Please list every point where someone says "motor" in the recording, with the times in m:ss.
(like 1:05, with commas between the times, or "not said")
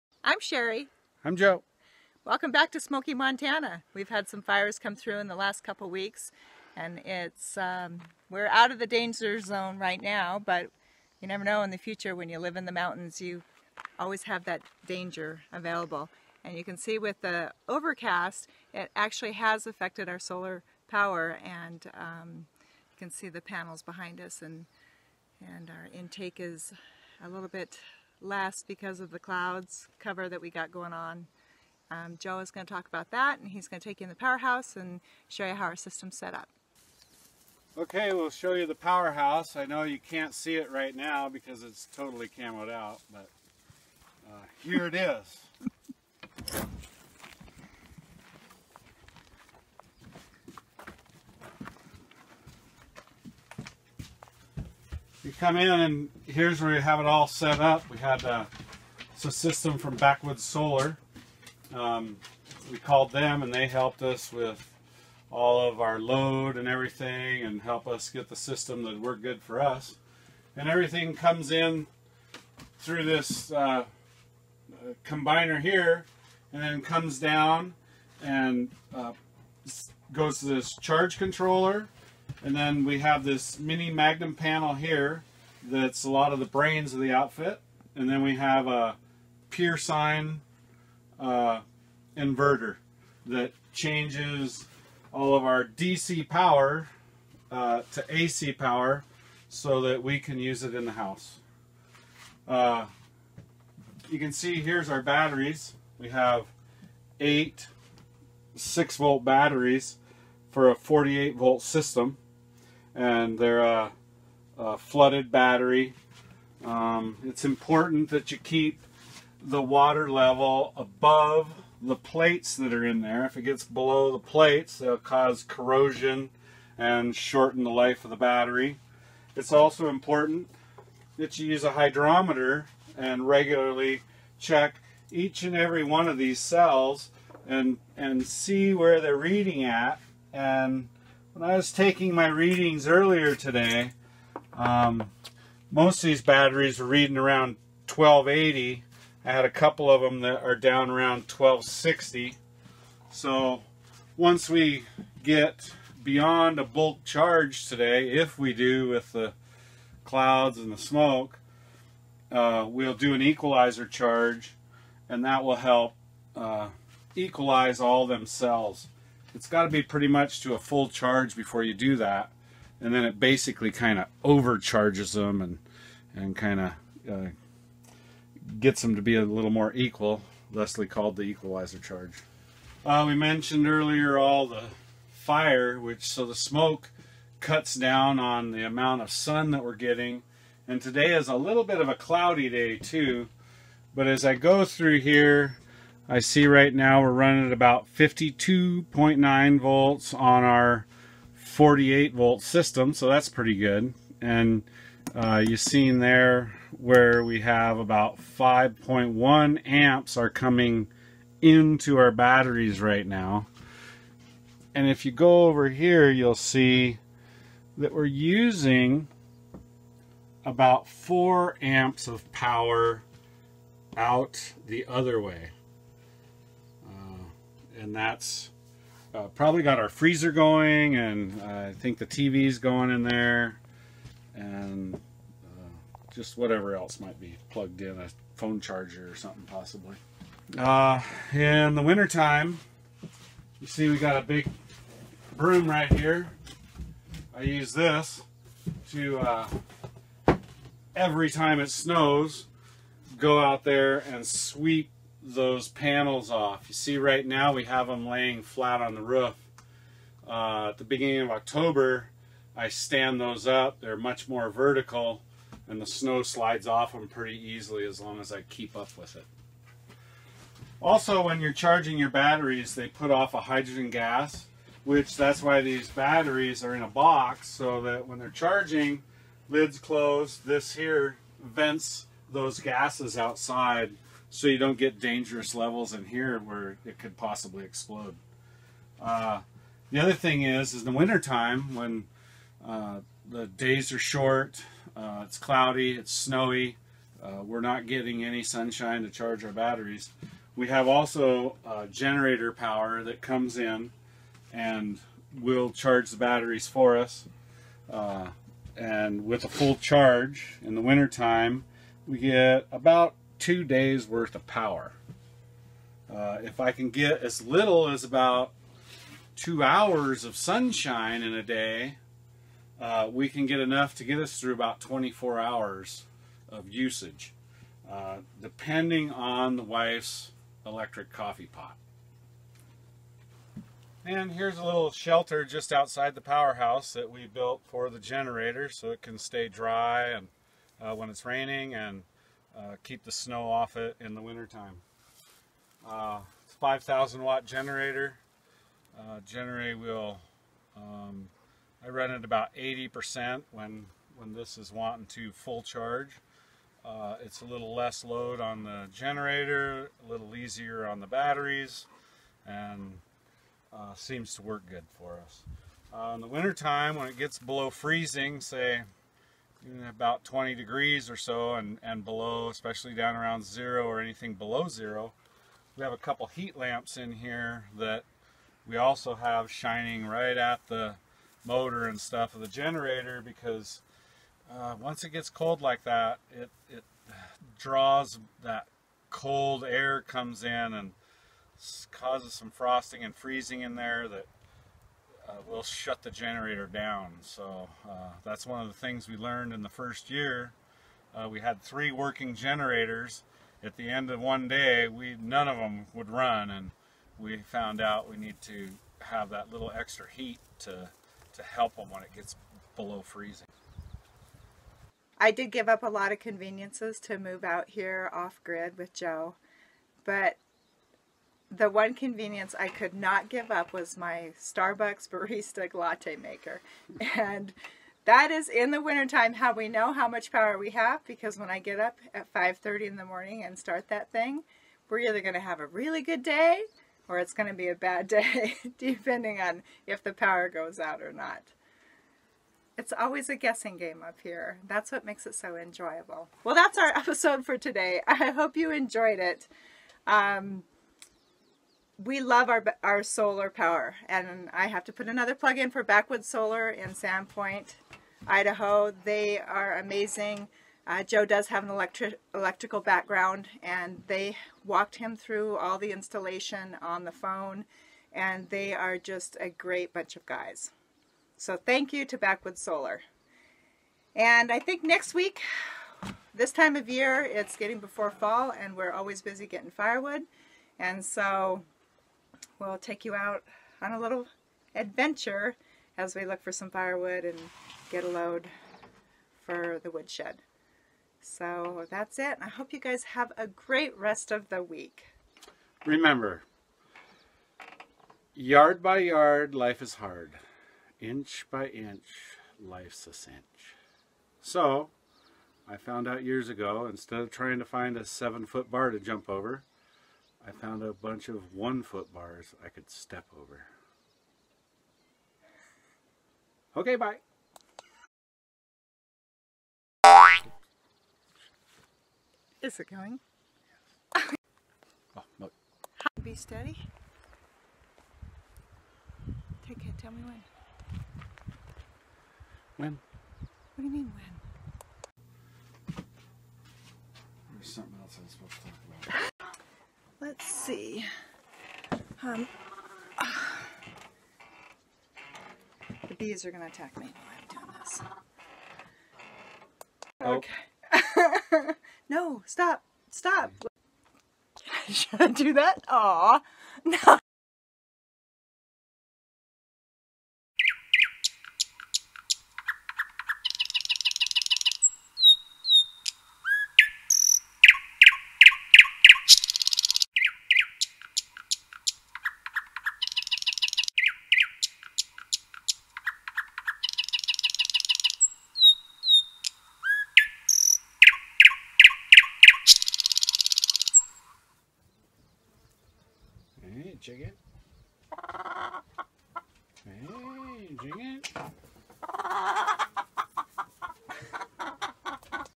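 6:21.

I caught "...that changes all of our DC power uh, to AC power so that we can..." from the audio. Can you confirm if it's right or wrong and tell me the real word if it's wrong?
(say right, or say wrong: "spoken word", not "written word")
right.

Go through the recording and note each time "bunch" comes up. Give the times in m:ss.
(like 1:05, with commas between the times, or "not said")
7:49, 8:30.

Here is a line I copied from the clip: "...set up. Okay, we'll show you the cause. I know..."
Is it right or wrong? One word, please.
wrong.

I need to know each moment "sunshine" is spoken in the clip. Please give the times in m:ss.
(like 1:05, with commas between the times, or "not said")
4:58, 5:20.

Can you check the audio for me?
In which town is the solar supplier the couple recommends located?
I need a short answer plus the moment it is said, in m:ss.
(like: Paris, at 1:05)
Sandpoint, Idaho, at 7:36.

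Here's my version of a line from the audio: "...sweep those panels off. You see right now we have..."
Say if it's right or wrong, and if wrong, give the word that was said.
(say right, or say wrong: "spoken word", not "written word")
right.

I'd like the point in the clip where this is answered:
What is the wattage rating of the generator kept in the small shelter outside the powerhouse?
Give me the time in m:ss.
5:46.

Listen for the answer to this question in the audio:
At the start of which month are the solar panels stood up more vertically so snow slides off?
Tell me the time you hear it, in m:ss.
4:21.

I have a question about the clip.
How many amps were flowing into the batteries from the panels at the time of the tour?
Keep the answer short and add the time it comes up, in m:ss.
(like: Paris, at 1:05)
5.1 amps, at 3:28.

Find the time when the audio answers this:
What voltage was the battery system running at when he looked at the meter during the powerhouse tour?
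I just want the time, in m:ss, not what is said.
3:17.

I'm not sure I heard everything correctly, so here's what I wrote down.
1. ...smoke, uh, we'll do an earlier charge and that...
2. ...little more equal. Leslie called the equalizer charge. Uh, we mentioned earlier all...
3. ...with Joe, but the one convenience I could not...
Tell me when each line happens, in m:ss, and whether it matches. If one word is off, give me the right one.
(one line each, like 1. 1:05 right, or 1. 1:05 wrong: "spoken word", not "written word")
1. 2:40 wrong: "equalizer", not "earlier"
2. 2:59 right
3. 6:58 right.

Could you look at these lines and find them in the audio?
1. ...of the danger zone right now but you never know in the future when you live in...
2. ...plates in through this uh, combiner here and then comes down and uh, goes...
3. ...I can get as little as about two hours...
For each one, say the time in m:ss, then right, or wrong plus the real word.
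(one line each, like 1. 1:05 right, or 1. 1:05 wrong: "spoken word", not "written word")
1. 0:08 right
2. 1:11 wrong: "comes", not "plates"
3. 5:16 right.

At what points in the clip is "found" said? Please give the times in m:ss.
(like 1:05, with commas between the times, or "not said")
6:47, 8:25, 8:30.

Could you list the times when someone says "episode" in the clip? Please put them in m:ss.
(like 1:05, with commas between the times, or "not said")
7:26.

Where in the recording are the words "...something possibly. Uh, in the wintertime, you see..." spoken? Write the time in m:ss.
3:59.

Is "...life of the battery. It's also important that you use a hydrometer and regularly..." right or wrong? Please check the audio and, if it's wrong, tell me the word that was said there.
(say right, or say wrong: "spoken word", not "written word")
right.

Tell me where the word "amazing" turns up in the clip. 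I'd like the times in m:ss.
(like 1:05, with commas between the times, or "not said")
7:39.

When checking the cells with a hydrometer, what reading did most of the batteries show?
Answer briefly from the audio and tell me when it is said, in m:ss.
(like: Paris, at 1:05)
1280, at 2:27.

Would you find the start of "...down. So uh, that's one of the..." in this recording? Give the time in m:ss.
6:36.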